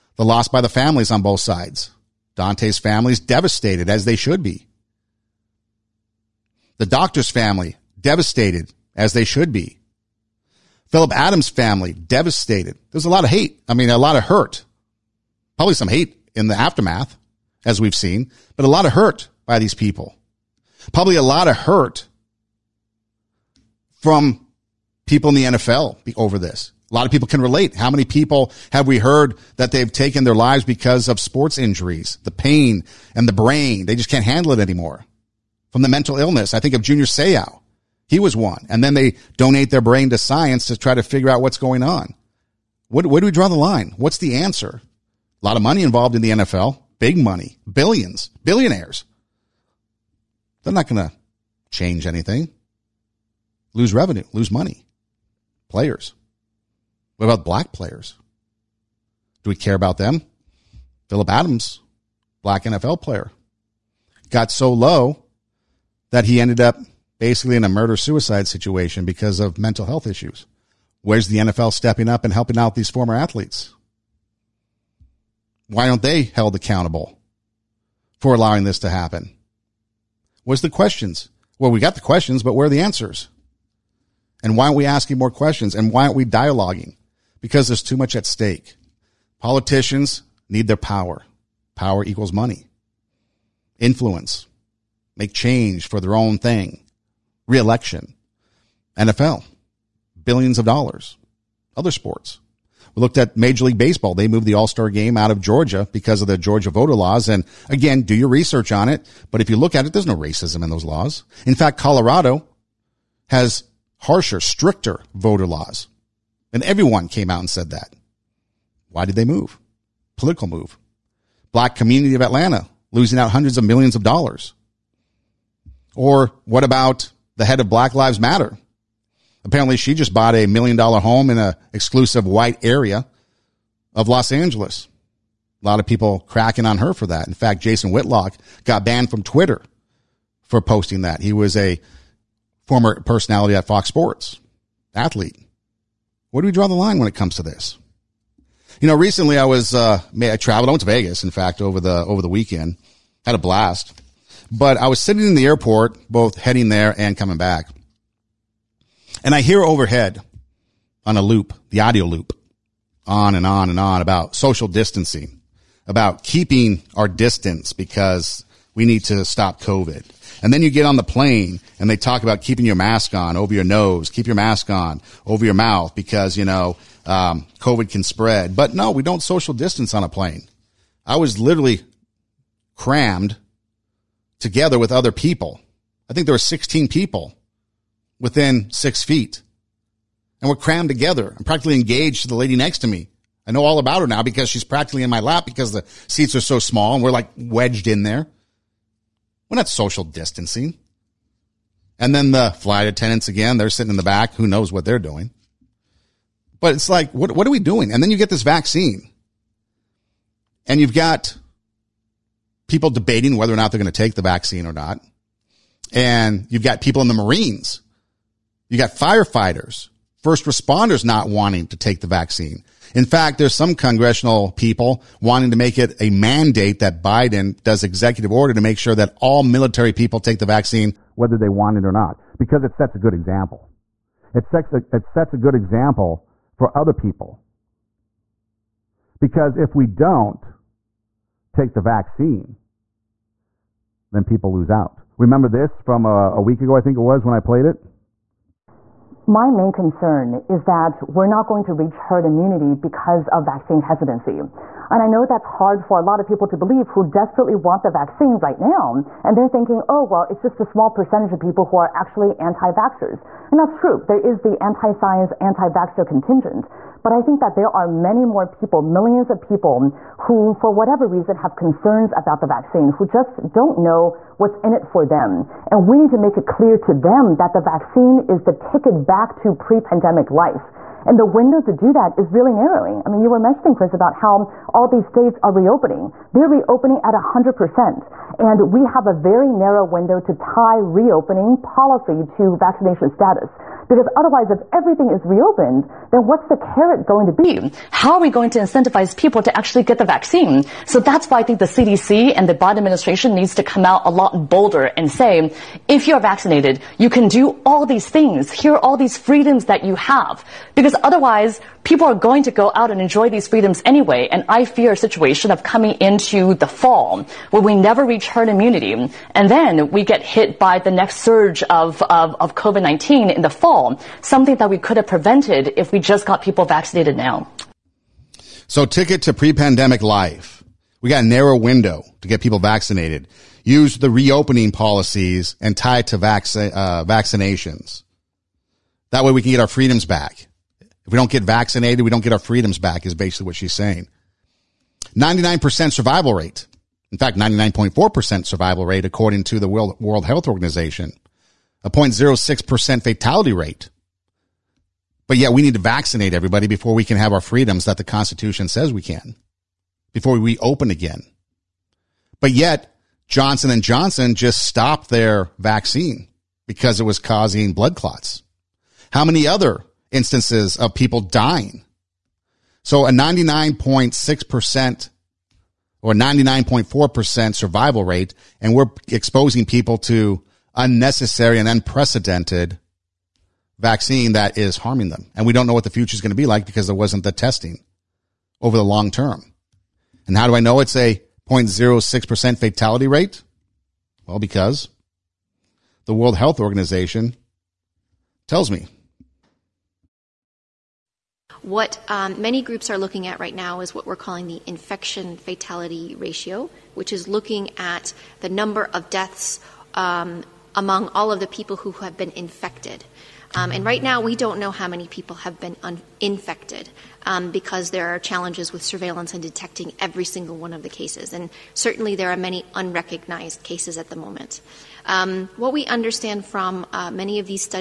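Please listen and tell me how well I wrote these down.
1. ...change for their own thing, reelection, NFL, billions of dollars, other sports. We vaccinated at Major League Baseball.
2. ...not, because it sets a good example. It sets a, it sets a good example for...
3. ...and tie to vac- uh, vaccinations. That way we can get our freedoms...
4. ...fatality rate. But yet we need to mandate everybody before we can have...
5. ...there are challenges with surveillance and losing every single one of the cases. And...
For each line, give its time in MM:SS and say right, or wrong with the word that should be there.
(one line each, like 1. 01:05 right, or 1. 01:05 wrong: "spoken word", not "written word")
1. 01:35 wrong: "looked", not "vaccinated"
2. 03:51 right
3. 05:35 right
4. 05:53 wrong: "vaccinate", not "mandate"
5. 06:57 wrong: "detecting", not "losing".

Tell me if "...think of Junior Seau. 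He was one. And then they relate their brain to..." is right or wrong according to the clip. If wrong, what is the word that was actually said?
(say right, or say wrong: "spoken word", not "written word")
wrong: "donate", not "relate".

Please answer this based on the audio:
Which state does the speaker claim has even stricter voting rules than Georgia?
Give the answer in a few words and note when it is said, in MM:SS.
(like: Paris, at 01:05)
Colorado, at 01:51.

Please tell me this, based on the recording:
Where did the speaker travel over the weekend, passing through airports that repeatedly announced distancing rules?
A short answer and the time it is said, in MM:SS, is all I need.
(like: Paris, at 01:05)
Vegas, at 02:30.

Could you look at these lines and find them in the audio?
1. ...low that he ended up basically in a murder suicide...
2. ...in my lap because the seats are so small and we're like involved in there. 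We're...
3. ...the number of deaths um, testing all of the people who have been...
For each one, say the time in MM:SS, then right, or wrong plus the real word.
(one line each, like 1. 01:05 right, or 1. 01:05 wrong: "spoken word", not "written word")
1. 01:04 right
2. 03:15 wrong: "wedged", not "involved"
3. 06:48 wrong: "among", not "testing".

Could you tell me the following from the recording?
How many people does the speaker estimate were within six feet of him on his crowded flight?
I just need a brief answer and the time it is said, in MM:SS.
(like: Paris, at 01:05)
16, at 03:06.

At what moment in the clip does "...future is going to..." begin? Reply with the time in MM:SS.
06:25.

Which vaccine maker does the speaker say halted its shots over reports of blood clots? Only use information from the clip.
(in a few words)
Johnson and Johnson.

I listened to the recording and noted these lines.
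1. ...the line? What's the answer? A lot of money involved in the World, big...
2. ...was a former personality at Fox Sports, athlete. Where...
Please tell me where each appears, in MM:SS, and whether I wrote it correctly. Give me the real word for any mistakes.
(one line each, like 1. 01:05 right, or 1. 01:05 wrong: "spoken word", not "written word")
1. 00:43 wrong: "NFL", not "World"
2. 02:21 right.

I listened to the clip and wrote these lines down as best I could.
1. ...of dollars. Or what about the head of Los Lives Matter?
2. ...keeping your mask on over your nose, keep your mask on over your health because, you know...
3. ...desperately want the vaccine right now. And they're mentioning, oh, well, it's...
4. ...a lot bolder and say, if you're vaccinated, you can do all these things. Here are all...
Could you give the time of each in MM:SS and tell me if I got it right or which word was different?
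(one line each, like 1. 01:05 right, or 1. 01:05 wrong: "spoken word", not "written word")
1. 02:03 wrong: "Black", not "Los"
2. 02:52 wrong: "mouth", not "health"
3. 04:17 wrong: "thinking", not "mentioning"
4. 05:04 right.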